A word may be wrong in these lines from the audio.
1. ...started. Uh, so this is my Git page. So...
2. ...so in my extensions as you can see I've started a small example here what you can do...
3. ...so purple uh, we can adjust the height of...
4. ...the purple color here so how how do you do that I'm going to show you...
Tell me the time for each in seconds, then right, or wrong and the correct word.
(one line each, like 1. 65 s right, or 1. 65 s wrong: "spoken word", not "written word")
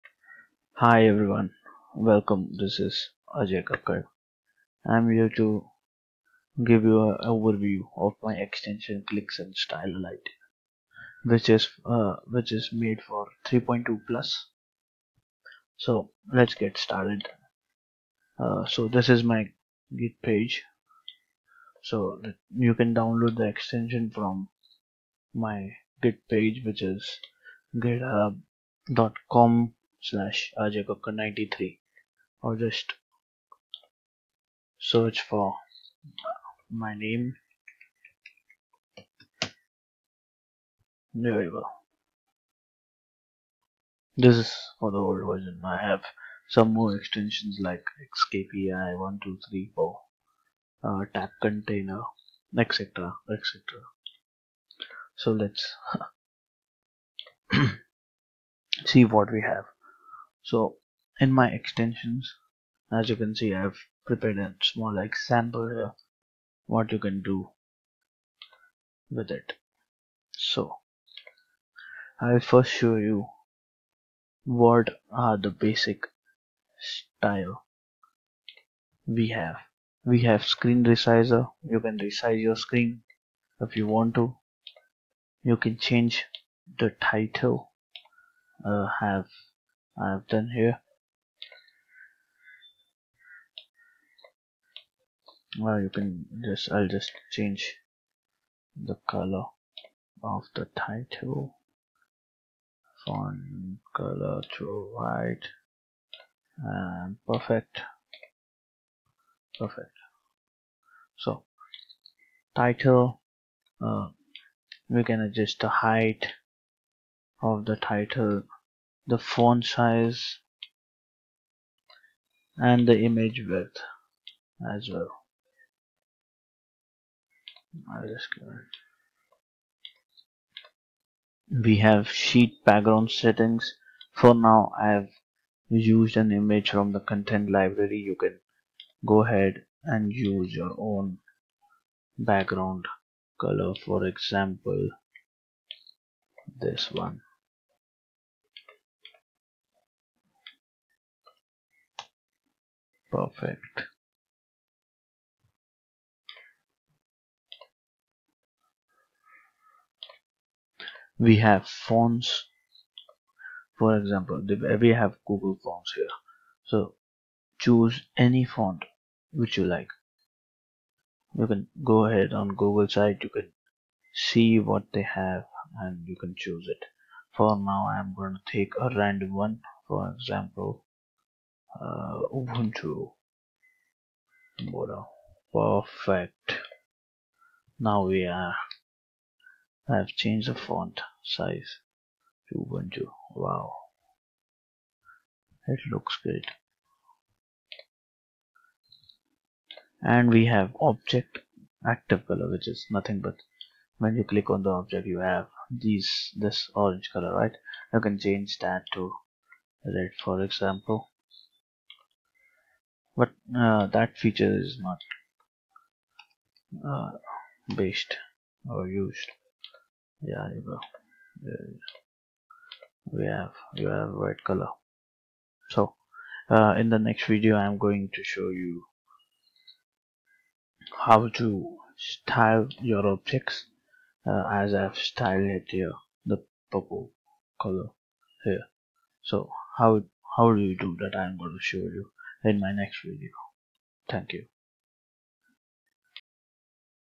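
1. 16 s right
2. 60 s wrong: "prepared", not "started"
3. 111 s wrong: "title", not "purple"
4. 236 s right.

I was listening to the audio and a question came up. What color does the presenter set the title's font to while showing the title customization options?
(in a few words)
White.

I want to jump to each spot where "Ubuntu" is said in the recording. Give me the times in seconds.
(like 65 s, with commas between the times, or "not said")
182 s, 192 s.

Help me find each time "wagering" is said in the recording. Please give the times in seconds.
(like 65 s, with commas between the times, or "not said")
not said.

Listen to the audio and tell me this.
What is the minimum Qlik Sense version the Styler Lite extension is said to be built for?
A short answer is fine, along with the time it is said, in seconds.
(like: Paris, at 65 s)
3.2, at 13 s.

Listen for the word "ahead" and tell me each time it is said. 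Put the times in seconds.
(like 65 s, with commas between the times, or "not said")
139 s, 172 s.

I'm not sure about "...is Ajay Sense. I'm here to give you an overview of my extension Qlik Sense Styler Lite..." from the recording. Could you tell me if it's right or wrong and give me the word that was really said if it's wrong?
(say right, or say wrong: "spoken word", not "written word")
wrong: "Kakkar", not "Sense".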